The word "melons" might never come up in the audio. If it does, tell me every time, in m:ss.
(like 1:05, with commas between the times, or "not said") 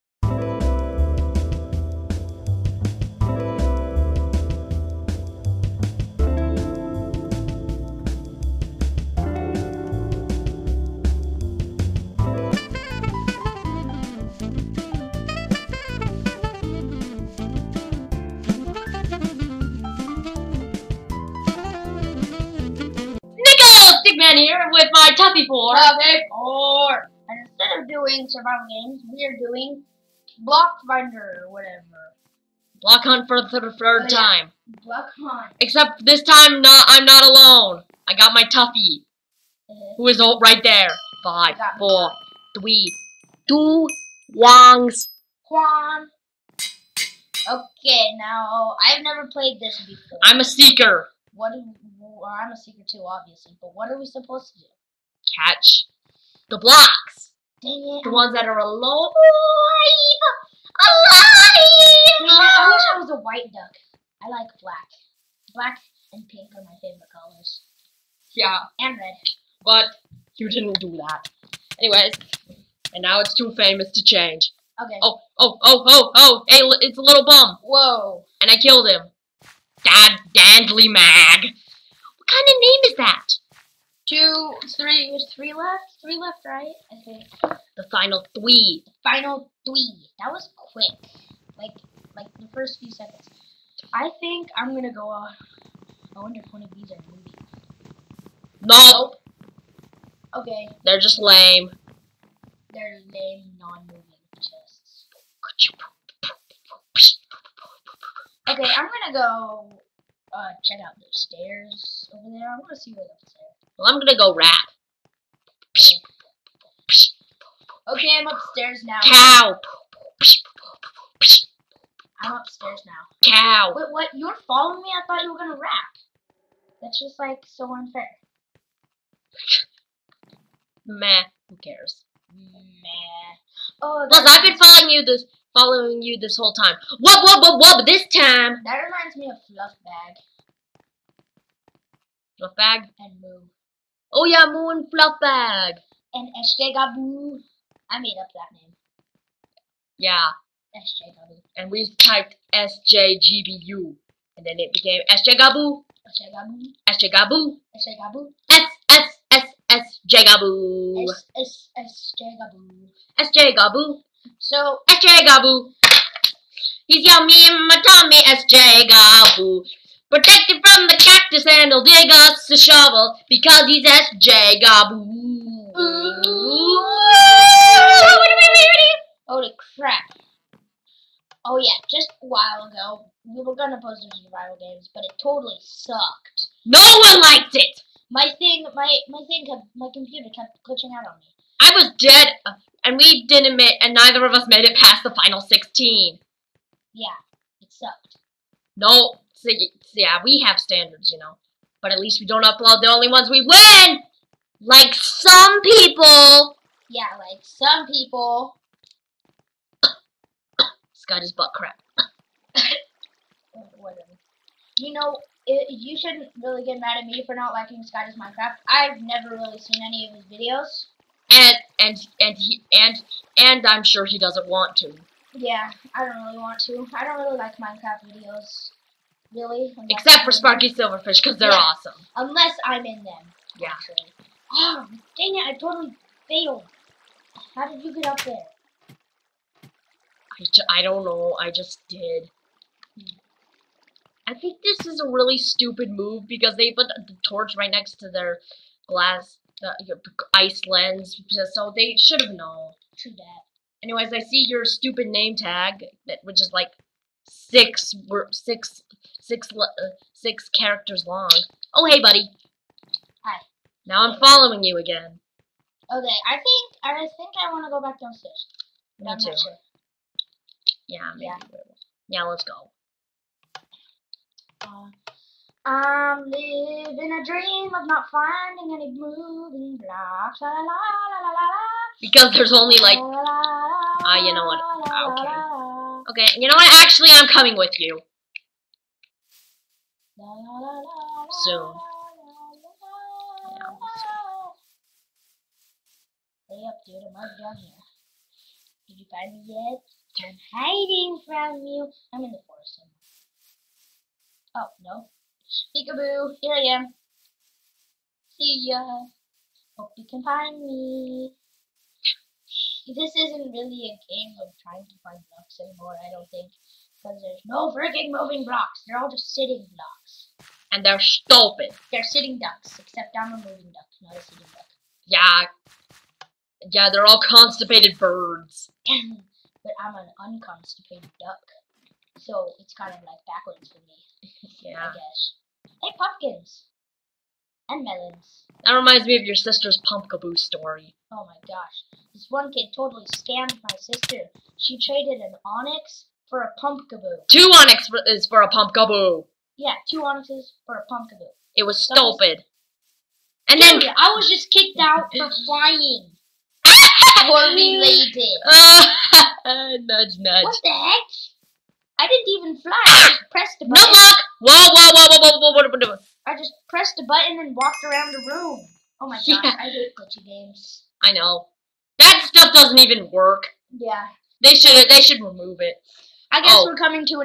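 5:37.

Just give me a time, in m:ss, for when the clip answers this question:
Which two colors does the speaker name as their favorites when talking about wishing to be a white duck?
1:05.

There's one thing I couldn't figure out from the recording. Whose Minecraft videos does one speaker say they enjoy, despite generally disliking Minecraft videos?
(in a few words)
Sparky Silverfish.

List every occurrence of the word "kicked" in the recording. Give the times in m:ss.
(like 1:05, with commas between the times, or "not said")
5:54.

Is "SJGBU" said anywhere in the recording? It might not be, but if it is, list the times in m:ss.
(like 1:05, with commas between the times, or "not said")
2:32.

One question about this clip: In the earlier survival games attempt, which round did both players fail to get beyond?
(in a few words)
final 16.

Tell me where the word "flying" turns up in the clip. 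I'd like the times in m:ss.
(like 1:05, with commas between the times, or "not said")
5:55.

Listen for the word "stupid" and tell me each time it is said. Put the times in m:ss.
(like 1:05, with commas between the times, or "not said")
4:05, 4:14, 5:21, 5:51.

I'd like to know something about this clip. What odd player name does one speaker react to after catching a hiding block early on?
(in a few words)
Dad Dandly Mag.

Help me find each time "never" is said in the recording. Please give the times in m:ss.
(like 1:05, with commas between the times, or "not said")
0:49, 3:39.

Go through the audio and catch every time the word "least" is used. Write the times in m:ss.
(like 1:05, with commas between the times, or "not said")
3:21.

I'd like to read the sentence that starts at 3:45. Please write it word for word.
Yeah, I don't really want to.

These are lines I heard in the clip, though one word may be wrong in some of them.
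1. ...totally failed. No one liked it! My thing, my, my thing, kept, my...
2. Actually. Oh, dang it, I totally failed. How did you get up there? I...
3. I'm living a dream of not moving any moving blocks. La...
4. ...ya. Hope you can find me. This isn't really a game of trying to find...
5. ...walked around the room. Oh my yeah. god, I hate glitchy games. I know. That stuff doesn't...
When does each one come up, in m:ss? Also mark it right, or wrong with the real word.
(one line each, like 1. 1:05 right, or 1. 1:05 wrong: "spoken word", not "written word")
1. 3:05 wrong: "sucked", not "failed"
2. 3:53 right
3. 4:35 wrong: "finding", not "moving"
4. 5:08 right
5. 6:07 right.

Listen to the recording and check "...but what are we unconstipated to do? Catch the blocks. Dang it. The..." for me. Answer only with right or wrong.
wrong.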